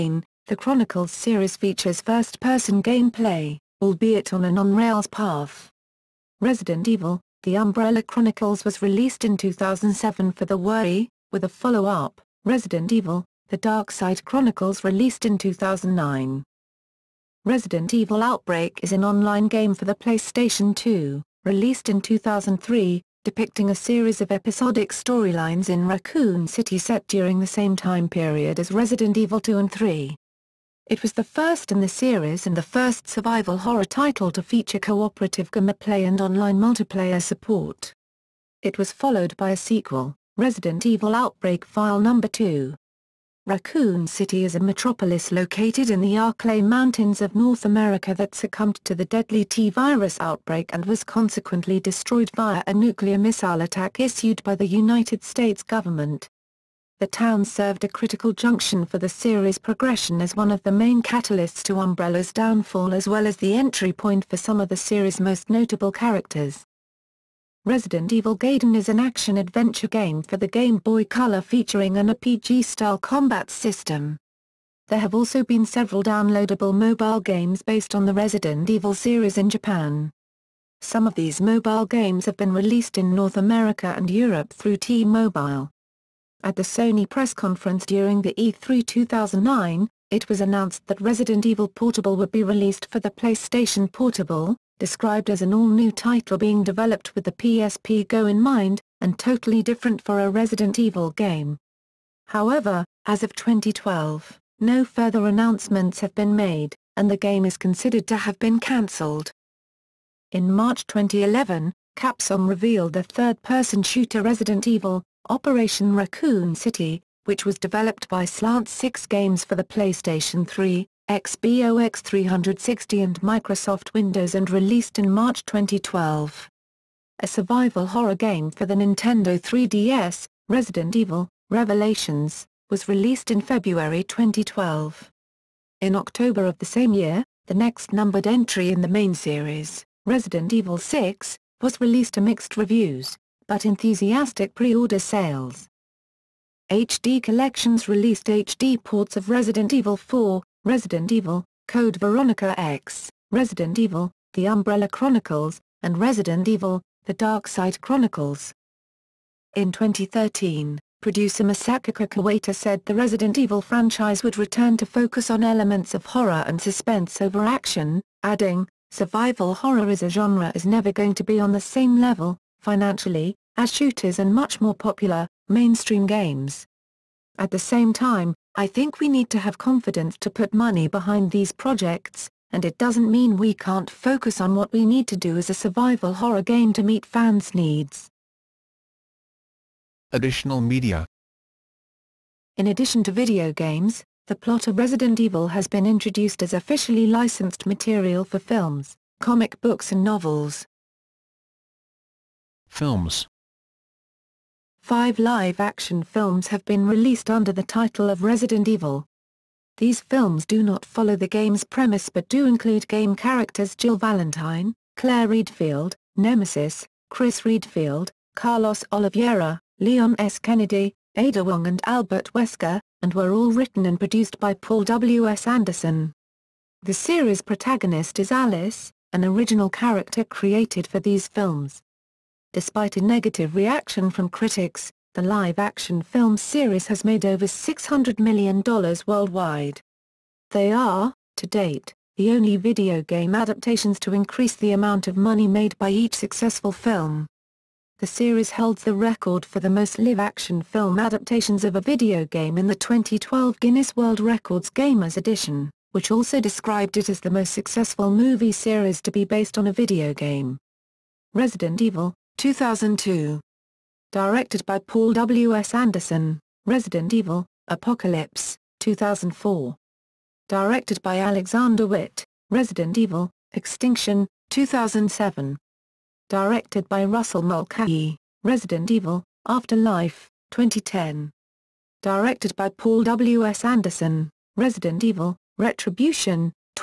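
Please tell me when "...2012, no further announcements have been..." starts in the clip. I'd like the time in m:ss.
1:43.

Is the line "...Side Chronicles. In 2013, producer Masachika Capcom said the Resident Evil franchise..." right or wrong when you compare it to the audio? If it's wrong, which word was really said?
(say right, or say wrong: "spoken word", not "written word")
wrong: "Kawata", not "Capcom".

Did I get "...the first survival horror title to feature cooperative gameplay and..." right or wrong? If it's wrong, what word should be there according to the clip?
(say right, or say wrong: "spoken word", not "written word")
right.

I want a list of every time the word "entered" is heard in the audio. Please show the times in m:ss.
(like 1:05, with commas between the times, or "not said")
not said.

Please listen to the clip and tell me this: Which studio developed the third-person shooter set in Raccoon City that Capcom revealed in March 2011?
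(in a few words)
Slant 6 Games.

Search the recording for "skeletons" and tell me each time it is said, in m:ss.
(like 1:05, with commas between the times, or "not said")
not said.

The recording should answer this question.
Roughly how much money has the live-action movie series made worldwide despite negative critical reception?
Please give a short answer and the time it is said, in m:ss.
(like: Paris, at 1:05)
over $600 million, at 3:57.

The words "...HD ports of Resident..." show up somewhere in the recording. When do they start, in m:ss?
2:28.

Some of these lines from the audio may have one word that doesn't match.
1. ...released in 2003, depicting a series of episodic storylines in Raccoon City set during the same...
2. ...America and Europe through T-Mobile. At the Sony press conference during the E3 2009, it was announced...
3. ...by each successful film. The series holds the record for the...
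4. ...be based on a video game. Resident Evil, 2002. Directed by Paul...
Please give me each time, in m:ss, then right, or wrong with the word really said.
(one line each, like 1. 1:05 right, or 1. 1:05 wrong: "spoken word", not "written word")
1. 0:21 right
2. 1:23 right
3. 4:05 right
4. 4:19 right.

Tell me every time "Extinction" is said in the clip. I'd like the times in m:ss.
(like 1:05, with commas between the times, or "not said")
4:33.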